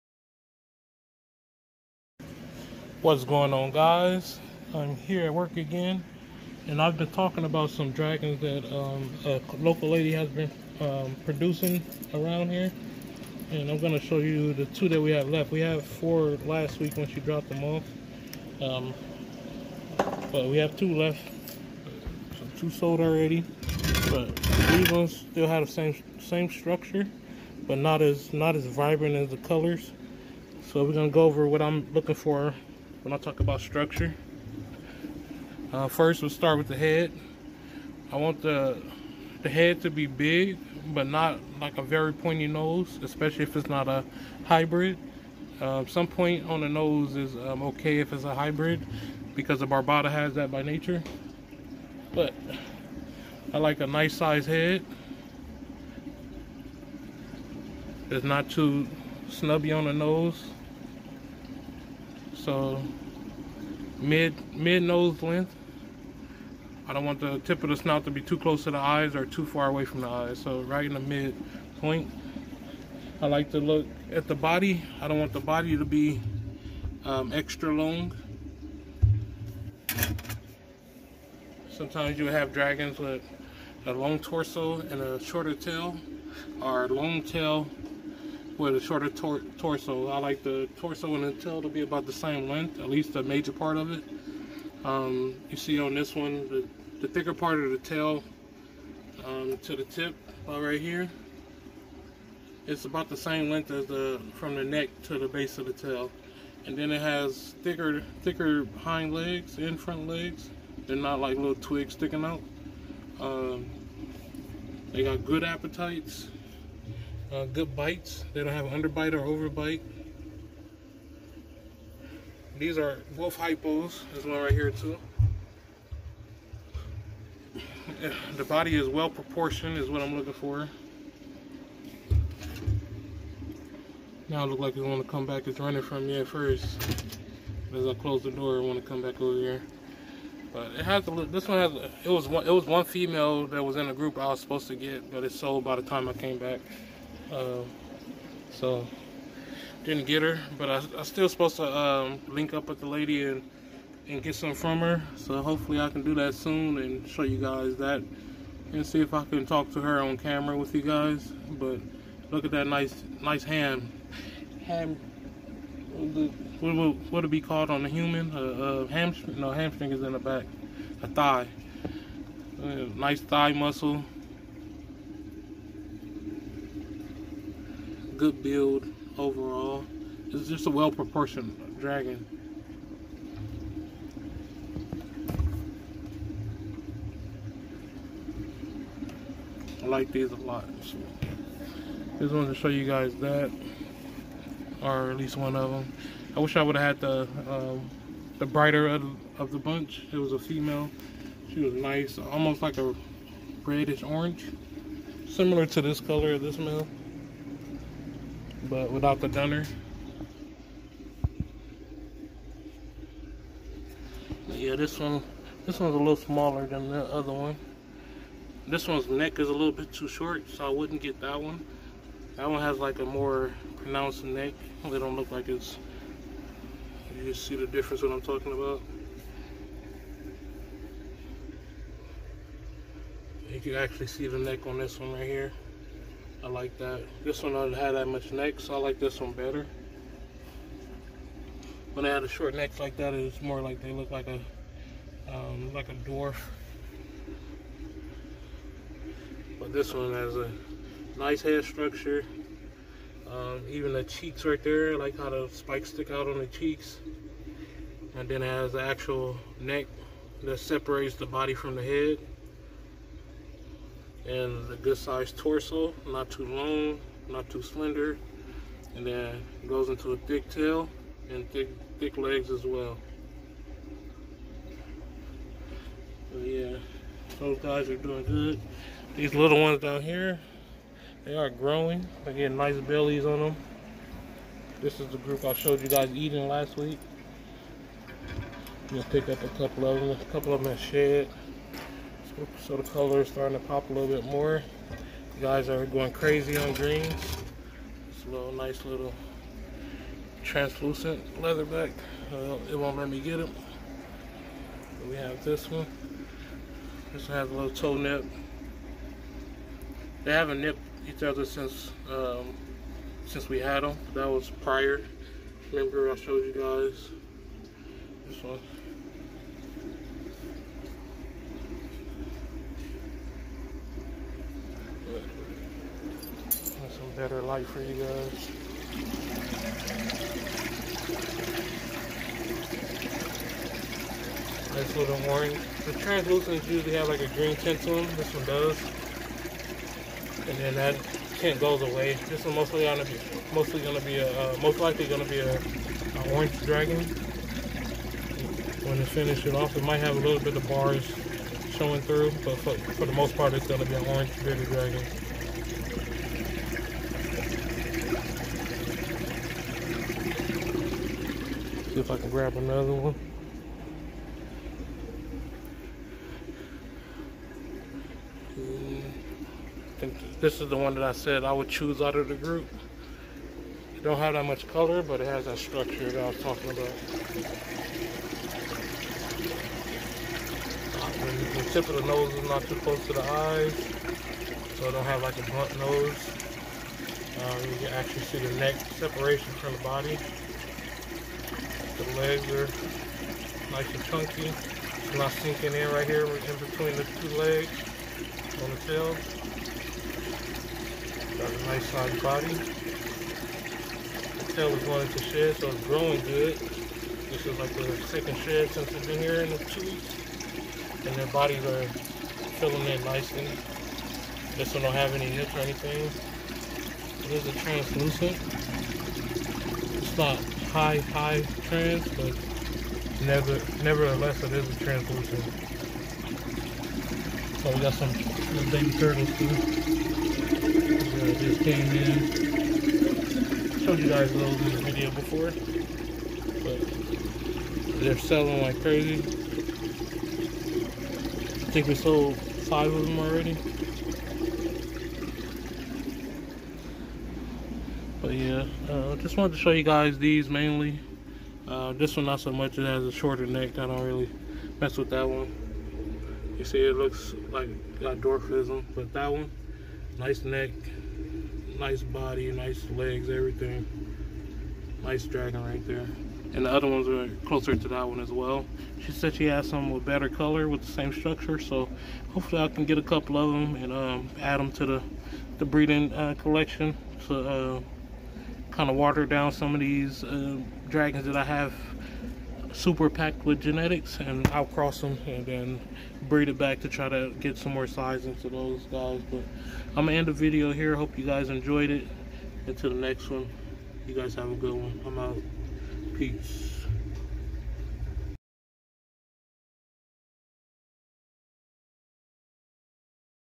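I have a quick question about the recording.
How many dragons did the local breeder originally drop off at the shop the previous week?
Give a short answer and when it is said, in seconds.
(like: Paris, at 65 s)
4, at 15 s.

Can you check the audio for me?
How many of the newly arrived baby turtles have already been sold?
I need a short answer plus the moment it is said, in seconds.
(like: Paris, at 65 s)
5, at 442 s.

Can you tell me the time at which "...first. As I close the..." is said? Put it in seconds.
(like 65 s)
136 s.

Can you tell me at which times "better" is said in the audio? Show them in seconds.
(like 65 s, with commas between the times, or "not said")
239 s, 327 s, 470 s.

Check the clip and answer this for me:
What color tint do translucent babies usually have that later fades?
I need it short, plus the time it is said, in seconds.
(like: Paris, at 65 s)
Green, at 337 s.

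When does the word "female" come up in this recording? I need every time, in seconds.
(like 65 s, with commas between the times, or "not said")
142 s, 200 s.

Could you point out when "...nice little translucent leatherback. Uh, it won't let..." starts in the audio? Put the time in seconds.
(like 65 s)
298 s.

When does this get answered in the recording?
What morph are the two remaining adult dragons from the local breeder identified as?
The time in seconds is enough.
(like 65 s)
123 s.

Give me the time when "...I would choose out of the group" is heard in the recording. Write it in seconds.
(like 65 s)
371 s.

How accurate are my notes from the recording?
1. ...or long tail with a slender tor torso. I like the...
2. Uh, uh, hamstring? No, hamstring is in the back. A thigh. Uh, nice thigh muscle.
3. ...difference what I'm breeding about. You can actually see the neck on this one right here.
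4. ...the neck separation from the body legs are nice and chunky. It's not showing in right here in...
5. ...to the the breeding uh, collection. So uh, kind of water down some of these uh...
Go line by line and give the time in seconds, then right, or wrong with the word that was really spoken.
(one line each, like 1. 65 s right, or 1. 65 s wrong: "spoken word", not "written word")
1. 86 s wrong: "shorter", not "slender"
2. 168 s right
3. 227 s wrong: "talking", not "breeding"
4. 388 s wrong: "sinking", not "showing"
5. 474 s right.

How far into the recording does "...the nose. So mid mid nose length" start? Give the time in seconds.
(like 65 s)
59 s.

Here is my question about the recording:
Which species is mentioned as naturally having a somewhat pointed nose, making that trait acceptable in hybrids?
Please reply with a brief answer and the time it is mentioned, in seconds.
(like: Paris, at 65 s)
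Barbata, at 49 s.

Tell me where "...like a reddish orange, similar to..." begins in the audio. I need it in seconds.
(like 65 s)
202 s.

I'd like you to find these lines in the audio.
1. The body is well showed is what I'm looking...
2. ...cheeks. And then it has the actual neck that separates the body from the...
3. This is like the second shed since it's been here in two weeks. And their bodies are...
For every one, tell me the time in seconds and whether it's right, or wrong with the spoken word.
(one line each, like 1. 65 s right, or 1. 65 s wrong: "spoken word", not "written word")
1. 128 s wrong: "proportioned", not "showed"
2. 256 s right
3. 406 s right.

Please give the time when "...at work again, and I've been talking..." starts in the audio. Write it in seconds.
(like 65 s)
5 s.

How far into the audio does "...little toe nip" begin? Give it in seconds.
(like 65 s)
307 s.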